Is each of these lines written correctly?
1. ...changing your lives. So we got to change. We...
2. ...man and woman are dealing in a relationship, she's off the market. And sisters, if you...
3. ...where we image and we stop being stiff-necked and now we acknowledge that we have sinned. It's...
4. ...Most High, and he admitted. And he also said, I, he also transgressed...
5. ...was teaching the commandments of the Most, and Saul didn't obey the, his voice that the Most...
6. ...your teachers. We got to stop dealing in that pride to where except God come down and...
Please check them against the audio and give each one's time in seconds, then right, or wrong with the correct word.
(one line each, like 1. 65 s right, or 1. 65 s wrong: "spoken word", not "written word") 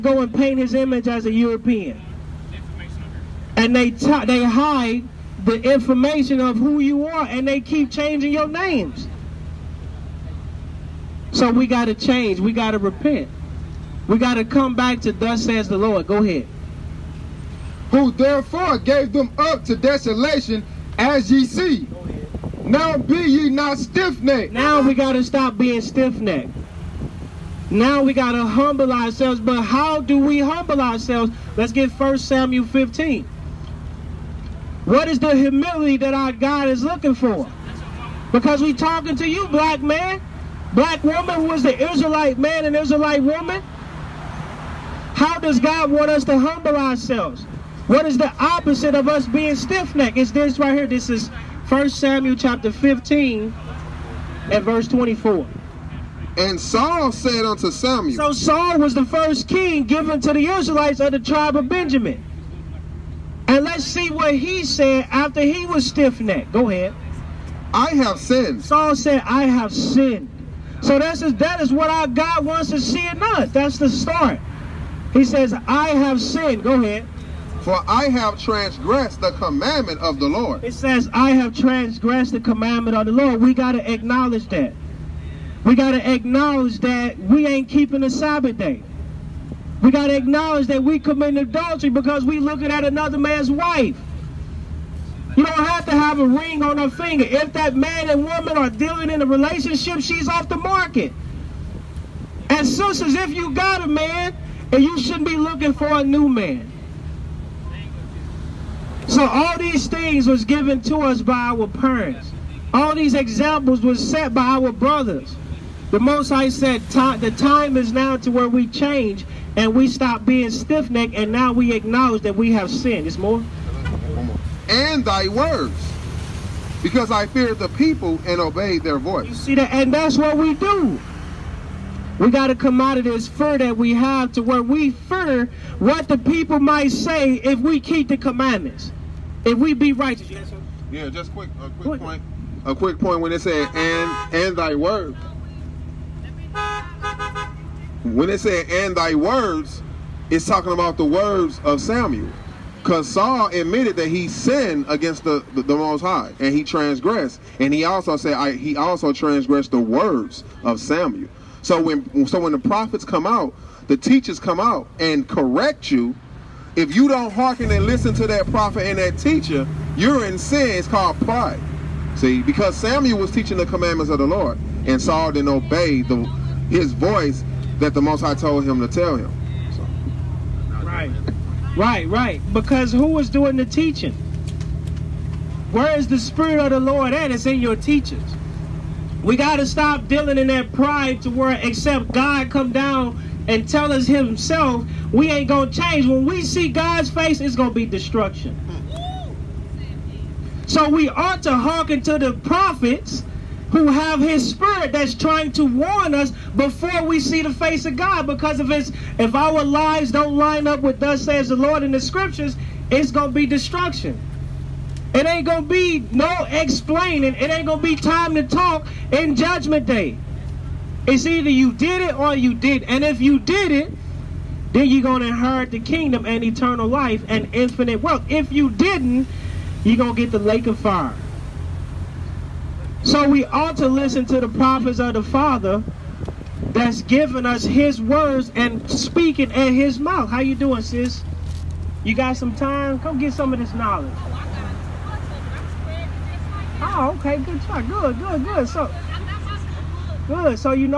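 1. 7 s wrong: "names", not "lives"
2. 97 s right
3. 118 s wrong: "change", not "image"
4. 155 s wrong: "transgressed", not "admitted"
5. 173 s wrong: "Lord", not "Most"
6. 187 s right.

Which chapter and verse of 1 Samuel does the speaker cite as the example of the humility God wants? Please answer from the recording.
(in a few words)
Chapter 15, verse 24.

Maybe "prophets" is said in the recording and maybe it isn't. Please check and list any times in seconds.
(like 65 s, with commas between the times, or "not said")
162 s, 168 s, 202 s, 234 s.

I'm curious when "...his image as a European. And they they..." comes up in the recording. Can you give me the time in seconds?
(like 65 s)
0 s.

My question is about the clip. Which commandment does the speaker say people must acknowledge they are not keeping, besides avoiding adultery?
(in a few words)
Keeping the Sabbath day.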